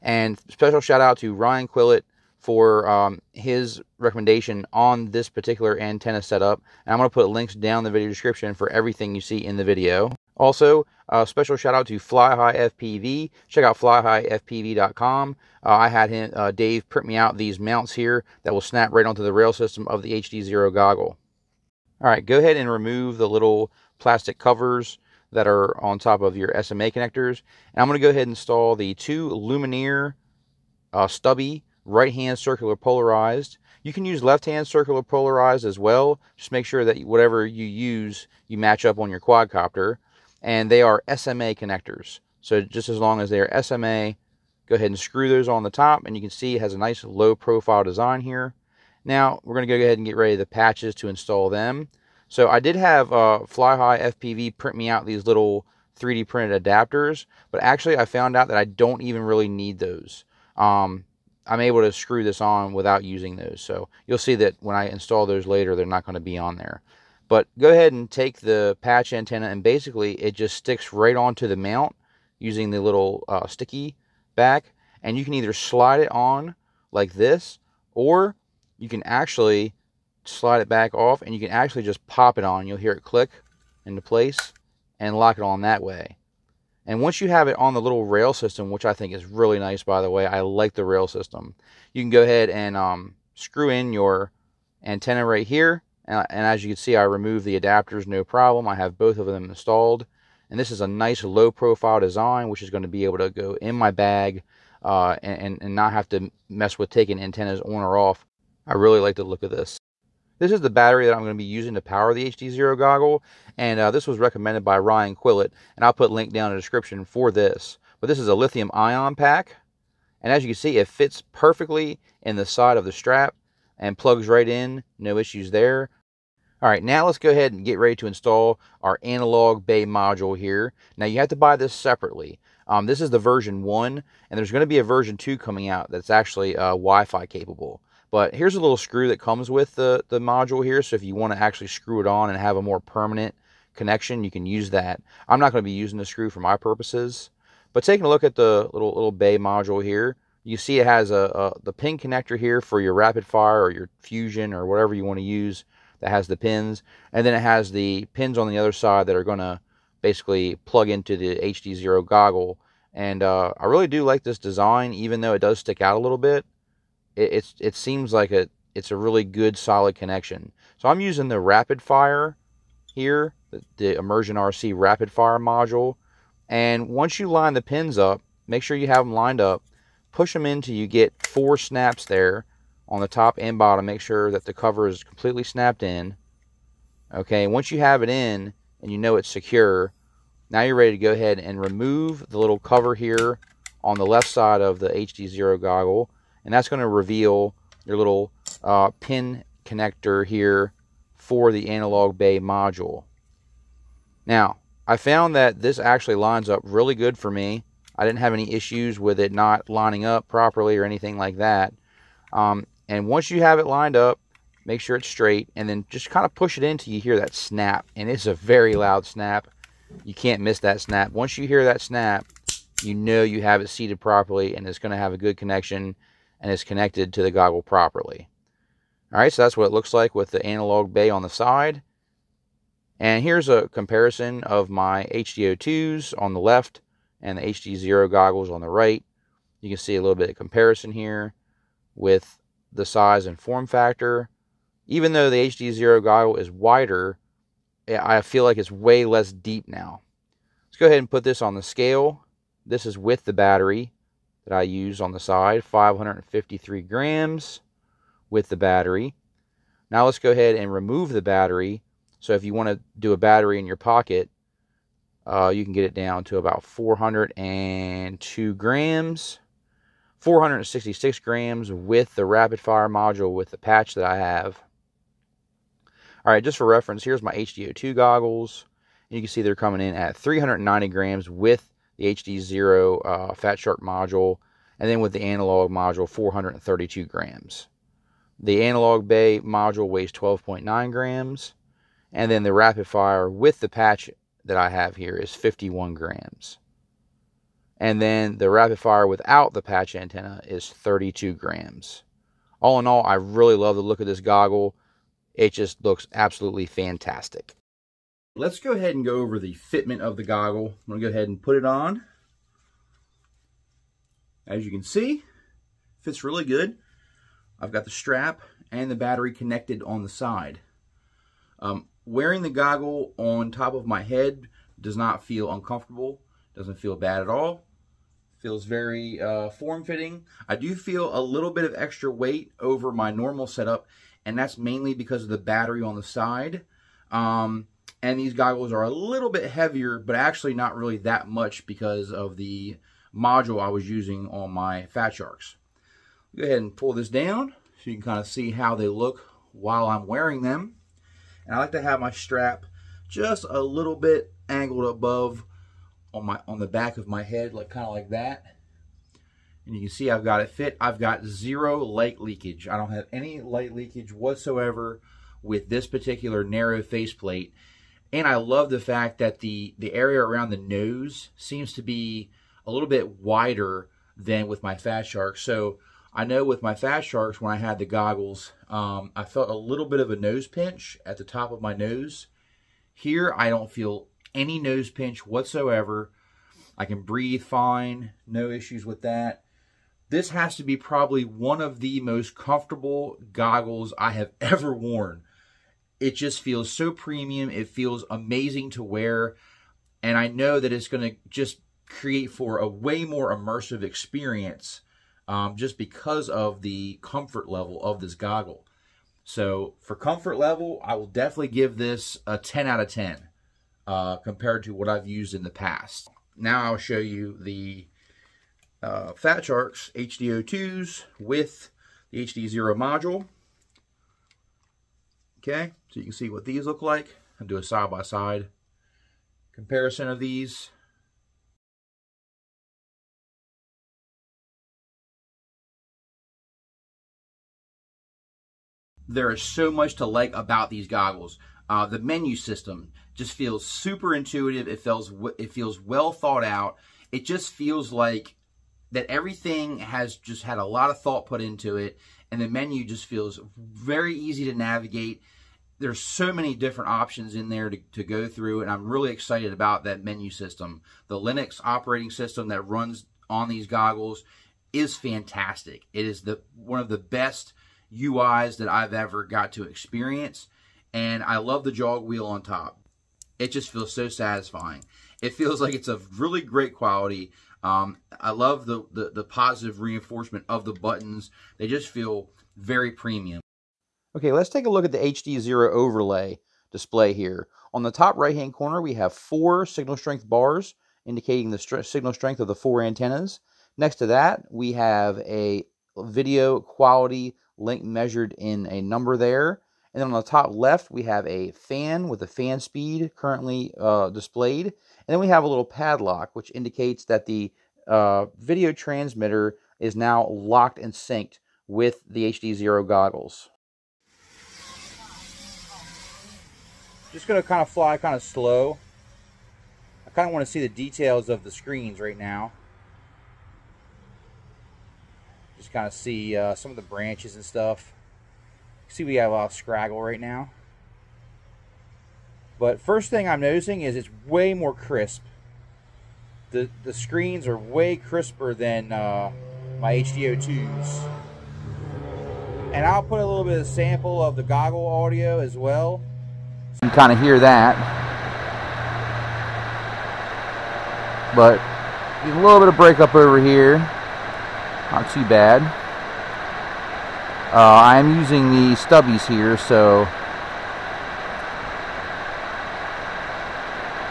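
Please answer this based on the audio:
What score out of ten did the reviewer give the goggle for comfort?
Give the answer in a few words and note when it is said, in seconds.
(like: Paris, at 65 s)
10, at 412 s.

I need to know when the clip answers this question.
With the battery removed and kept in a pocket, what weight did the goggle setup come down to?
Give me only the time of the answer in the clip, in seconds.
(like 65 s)
266 s.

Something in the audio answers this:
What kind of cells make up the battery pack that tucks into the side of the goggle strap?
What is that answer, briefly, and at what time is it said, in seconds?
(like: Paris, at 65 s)
lithium ion, at 118 s.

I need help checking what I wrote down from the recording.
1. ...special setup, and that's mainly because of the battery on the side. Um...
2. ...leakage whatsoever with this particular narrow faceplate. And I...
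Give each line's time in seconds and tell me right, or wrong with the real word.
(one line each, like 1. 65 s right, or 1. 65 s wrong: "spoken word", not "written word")
1. 333 s wrong: "normal", not "special"
2. 363 s right.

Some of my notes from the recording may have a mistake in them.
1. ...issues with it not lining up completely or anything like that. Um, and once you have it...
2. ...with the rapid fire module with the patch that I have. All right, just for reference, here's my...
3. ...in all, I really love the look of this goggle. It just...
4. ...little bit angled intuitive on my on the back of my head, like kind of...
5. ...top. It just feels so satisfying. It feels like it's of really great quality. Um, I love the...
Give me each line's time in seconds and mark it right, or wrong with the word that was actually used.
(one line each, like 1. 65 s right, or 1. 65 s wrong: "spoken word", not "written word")
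1. 208 s wrong: "properly", not "completely"
2. 271 s right
3. 302 s right
4. 353 s wrong: "above", not "intuitive"
5. 472 s right.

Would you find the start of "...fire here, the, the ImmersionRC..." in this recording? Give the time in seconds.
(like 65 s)
171 s.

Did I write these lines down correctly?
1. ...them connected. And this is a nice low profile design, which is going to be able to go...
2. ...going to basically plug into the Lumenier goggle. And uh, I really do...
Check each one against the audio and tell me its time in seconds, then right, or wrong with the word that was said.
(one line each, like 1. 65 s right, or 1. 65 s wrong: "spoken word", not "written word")
1. 99 s wrong: "installed", not "connected"
2. 159 s wrong: "HDZero", not "Lumenier".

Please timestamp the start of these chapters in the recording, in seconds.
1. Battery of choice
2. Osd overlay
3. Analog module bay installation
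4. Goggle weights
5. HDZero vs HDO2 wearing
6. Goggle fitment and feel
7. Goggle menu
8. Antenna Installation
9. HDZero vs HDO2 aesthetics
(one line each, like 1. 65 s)
1. 109 s
2. 483 s
3. 127 s
4. 249 s
5. 427 s
6. 308 s
7. 442 s
8. 22 s
9. 233 s.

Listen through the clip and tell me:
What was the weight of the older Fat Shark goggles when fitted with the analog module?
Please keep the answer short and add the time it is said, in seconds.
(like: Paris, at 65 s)
432 grams, at 286 s.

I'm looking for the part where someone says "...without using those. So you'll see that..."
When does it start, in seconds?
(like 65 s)
62 s.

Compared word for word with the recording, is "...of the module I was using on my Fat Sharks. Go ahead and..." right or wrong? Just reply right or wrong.
right.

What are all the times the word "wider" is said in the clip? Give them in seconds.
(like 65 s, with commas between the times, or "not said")
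246 s, 373 s.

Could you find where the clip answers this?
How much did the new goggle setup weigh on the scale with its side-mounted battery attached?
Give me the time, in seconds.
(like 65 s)
255 s.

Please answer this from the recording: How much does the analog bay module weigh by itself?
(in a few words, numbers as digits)
12.9 grams.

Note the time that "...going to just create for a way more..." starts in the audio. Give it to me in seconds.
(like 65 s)
400 s.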